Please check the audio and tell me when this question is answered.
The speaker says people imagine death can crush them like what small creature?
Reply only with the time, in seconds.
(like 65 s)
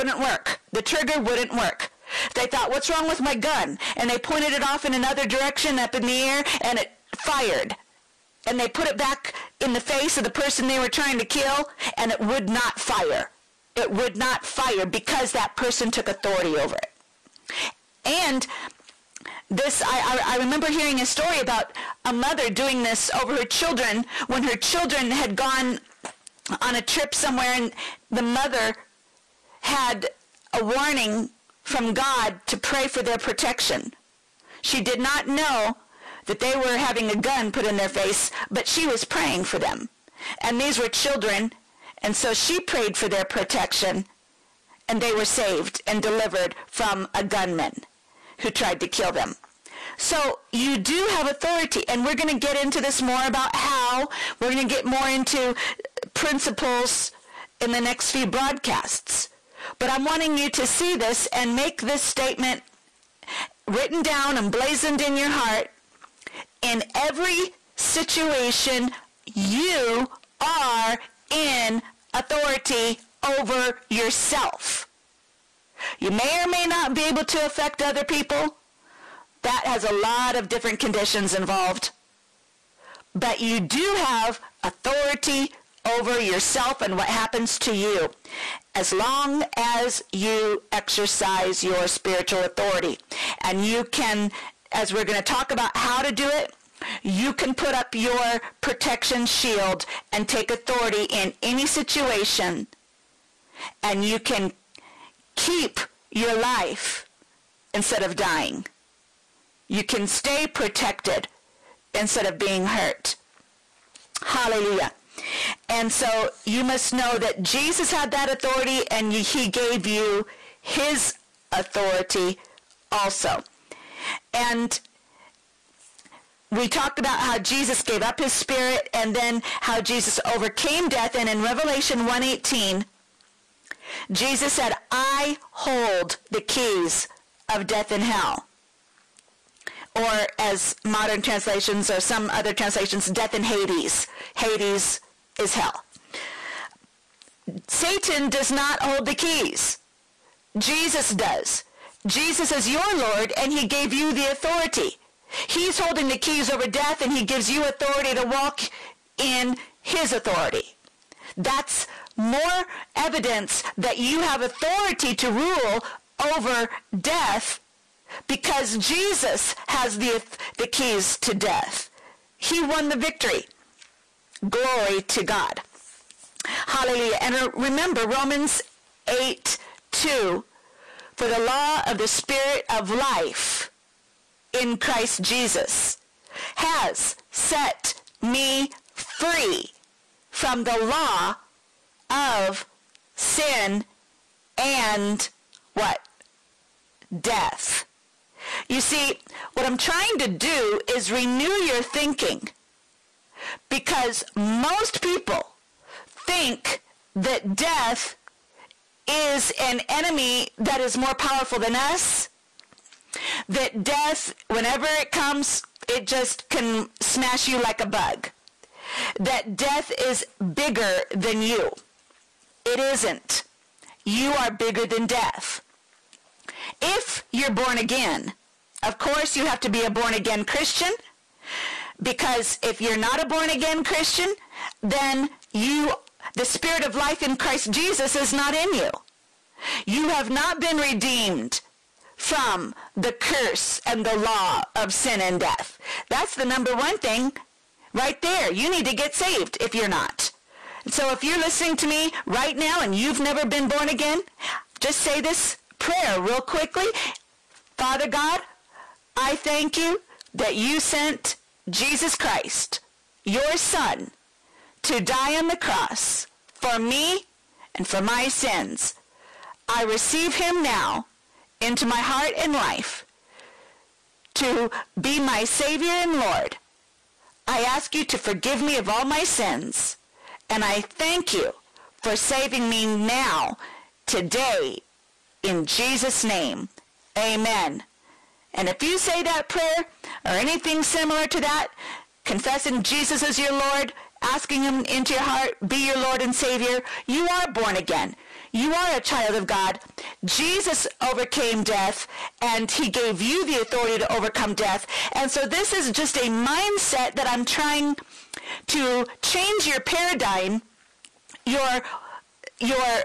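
217 s.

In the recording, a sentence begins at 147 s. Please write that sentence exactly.
Satan does not hold the keys.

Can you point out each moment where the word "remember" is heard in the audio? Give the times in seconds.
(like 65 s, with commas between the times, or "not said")
20 s, 177 s.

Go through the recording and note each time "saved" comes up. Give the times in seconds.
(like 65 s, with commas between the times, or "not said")
45 s, 249 s.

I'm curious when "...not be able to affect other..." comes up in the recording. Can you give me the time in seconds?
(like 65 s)
76 s.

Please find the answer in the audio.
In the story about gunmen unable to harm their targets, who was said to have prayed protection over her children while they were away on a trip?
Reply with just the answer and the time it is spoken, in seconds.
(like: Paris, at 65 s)
a mother, at 22 s.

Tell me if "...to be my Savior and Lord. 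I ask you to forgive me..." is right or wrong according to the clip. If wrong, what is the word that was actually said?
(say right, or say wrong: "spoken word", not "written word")
right.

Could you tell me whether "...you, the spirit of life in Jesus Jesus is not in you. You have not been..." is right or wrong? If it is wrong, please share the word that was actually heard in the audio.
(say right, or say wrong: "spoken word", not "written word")
wrong: "Christ", not "Jesus".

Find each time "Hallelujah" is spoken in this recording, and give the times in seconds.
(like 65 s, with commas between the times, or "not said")
114 s, 176 s.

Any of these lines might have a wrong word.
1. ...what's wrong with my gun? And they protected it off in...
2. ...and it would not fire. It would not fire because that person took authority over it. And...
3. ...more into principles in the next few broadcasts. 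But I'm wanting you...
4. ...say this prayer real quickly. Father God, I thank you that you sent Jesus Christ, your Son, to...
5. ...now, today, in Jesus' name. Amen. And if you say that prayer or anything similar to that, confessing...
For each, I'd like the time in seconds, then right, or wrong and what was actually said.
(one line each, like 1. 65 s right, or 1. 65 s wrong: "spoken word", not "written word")
1. 2 s wrong: "pointed", not "protected"
2. 11 s right
3. 54 s right
4. 254 s right
5. 282 s right.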